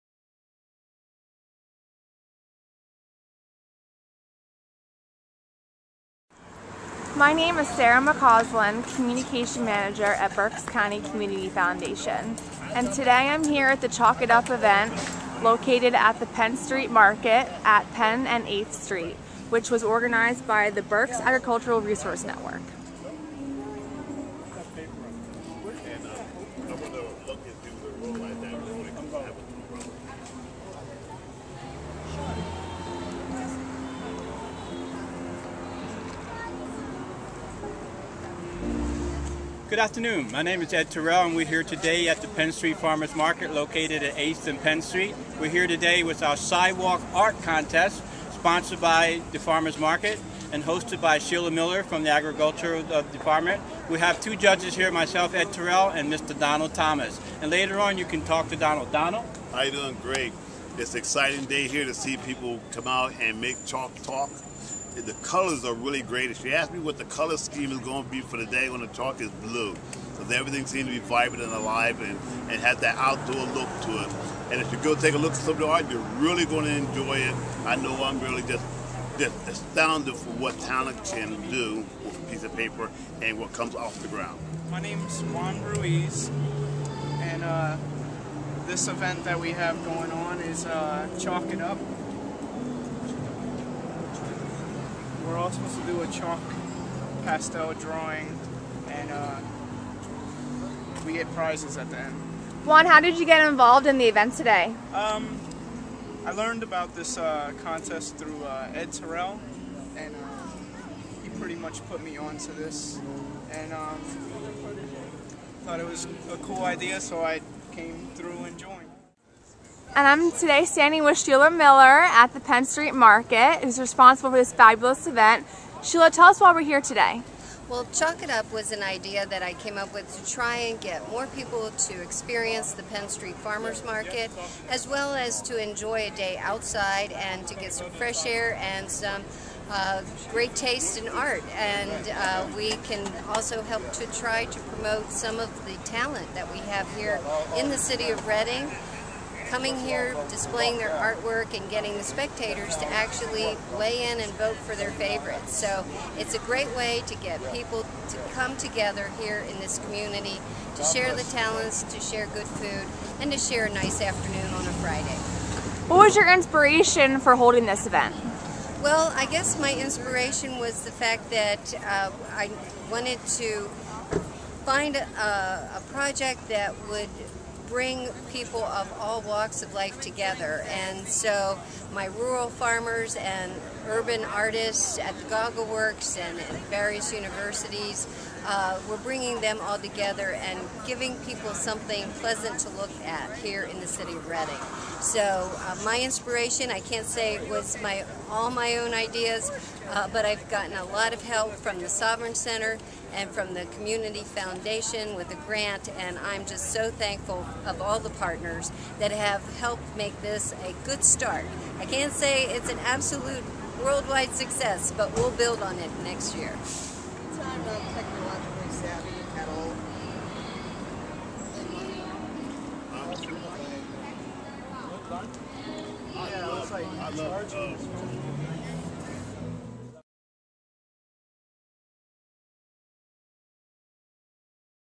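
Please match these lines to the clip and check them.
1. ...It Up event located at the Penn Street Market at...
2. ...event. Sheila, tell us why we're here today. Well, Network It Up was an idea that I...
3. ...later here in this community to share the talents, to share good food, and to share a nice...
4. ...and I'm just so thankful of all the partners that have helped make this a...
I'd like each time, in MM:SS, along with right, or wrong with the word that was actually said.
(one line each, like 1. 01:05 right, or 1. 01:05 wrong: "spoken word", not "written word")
1. 00:14 right
2. 02:05 wrong: "Chalk", not "Network"
3. 02:38 wrong: "together", not "later"
4. 03:25 right.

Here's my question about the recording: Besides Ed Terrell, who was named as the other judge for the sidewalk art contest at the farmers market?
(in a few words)
Donald Thomas.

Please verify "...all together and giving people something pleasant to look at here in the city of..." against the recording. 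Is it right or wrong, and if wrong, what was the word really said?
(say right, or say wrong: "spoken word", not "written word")
right.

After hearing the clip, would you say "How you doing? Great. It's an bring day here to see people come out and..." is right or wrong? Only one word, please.
wrong.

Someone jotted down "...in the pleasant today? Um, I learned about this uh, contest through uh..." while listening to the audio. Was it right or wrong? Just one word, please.
wrong.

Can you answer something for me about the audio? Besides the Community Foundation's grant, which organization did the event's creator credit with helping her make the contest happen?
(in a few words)
Sovereign Center.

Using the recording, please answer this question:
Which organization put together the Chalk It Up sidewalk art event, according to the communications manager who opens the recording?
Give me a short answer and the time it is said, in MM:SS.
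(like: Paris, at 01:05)
Berks Agricultural Resource Network, at 00:20.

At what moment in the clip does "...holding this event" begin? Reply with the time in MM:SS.
02:47.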